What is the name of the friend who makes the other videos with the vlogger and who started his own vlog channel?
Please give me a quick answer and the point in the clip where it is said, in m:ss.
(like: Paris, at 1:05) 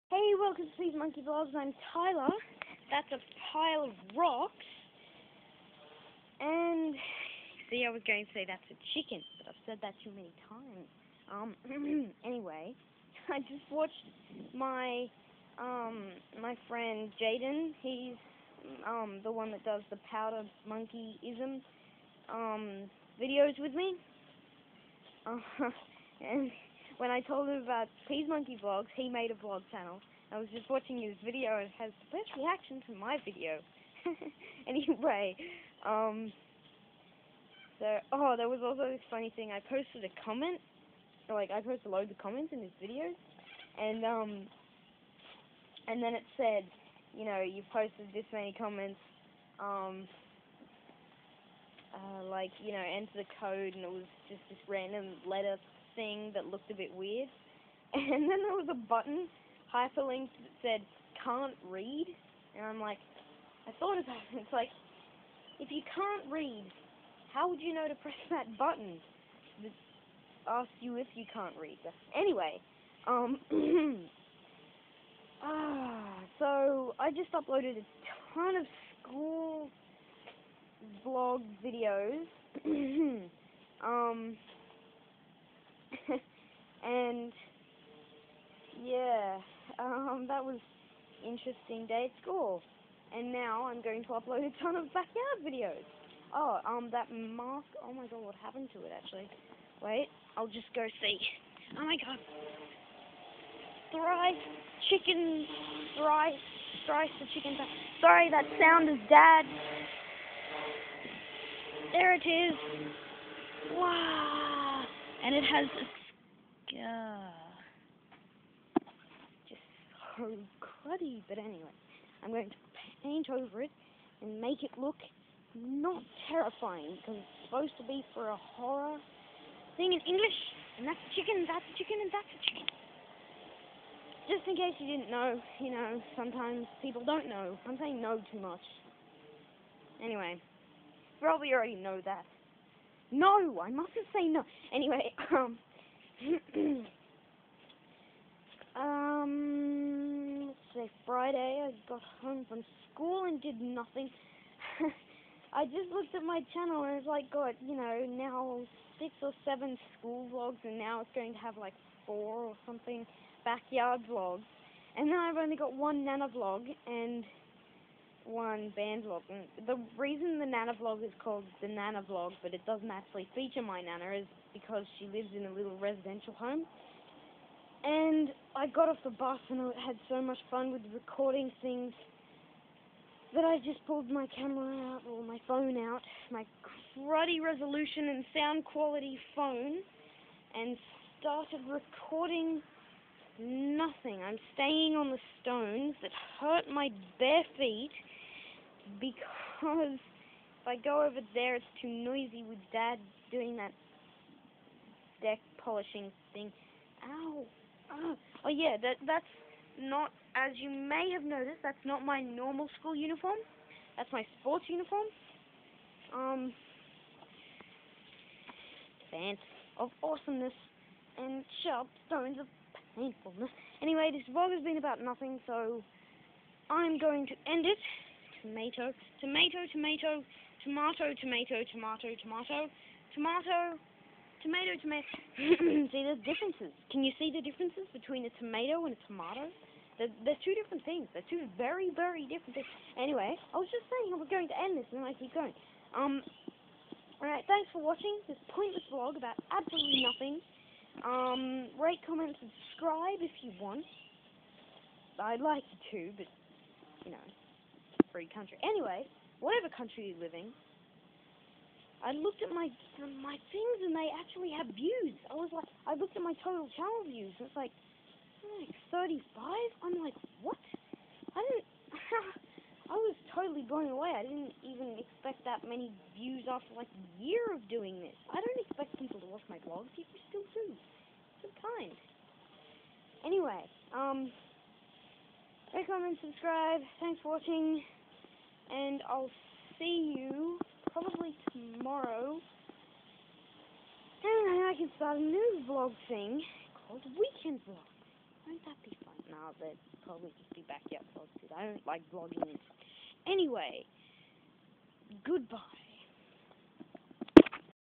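Jaden, at 0:17.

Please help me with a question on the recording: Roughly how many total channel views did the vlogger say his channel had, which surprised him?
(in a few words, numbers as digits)
35.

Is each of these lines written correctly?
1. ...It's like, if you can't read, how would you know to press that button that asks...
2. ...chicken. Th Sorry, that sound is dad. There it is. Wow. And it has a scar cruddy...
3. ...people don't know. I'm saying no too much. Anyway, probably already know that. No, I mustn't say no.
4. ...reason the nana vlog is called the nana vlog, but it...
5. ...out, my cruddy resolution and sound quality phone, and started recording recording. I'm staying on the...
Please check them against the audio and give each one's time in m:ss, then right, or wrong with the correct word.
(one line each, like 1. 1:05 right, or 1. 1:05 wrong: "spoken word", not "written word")
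1. 1:04 right
2. 1:47 right
3. 2:16 right
4. 2:49 right
5. 3:05 wrong: "nothing", not "recording".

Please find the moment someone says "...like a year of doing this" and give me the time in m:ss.
4:36.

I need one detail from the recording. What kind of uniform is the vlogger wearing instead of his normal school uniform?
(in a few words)
Sports uniform.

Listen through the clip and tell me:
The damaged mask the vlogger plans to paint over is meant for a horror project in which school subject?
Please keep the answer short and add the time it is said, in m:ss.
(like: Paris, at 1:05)
English, at 2:10.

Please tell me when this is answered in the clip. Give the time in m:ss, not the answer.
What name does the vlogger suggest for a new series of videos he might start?
4:57.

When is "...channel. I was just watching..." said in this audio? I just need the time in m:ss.
0:29.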